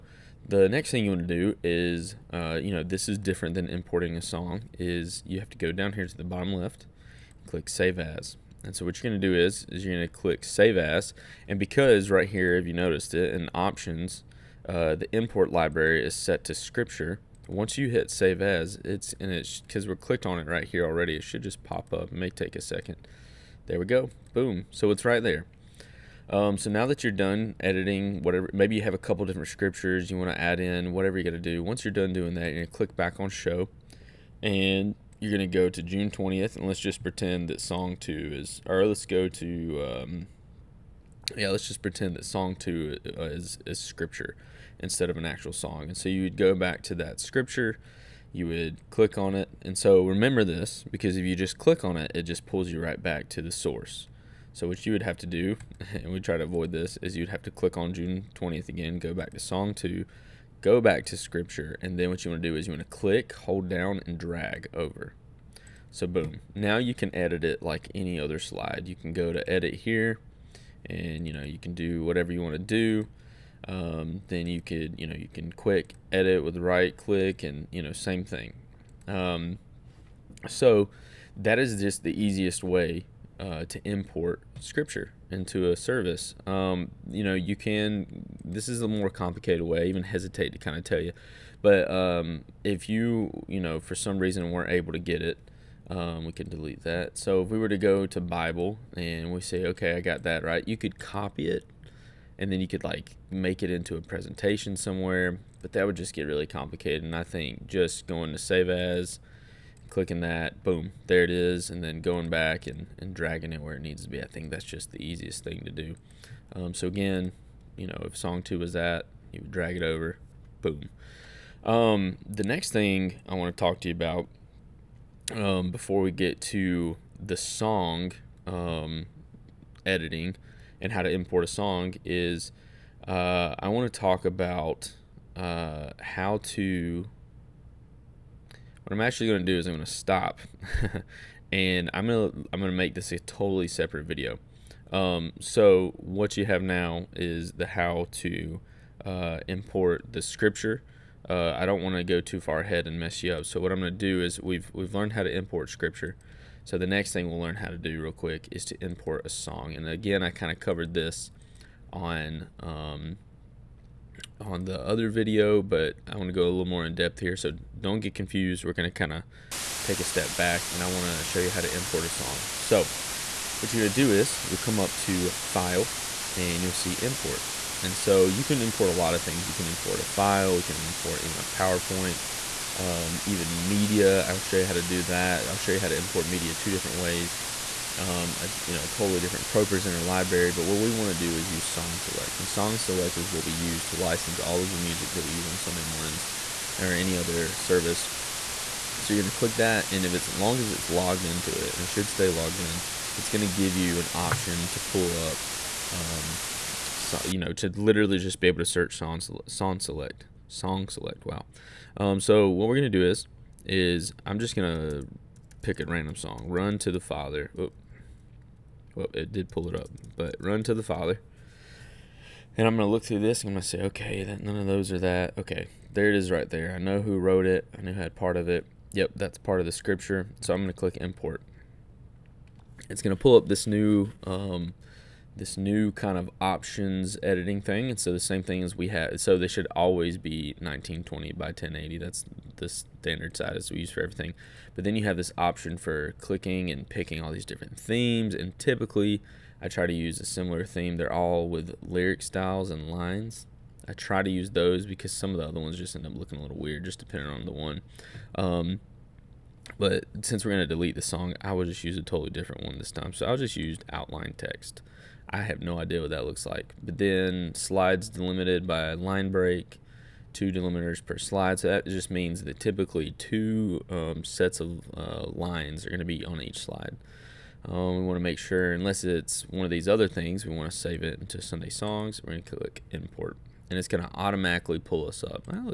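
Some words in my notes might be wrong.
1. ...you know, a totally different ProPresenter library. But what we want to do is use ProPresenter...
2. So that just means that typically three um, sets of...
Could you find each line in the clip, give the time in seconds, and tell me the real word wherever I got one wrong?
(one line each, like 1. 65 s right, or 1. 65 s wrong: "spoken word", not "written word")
1. 188 s wrong: "Song", not "ProPresenter"
2. 271 s wrong: "two", not "three".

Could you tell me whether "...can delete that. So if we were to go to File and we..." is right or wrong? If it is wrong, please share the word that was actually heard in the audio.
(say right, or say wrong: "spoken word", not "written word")
wrong: "Bible", not "File".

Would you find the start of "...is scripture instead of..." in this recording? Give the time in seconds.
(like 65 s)
43 s.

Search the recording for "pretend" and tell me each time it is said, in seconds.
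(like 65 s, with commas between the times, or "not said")
37 s, 41 s.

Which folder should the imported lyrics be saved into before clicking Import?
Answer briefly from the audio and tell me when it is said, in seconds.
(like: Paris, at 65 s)
Sunday Songs, at 281 s.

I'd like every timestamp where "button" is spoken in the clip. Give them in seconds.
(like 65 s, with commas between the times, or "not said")
not said.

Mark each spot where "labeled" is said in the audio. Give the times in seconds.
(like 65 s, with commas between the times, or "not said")
not said.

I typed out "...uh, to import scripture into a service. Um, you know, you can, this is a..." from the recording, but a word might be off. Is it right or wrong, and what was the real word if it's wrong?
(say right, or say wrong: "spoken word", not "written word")
right.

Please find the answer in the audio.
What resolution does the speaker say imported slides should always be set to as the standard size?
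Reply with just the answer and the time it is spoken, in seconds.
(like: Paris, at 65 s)
1920 by 1080, at 240 s.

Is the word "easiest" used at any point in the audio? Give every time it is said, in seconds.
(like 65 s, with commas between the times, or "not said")
82 s, 115 s.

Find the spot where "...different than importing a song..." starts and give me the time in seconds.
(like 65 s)
3 s.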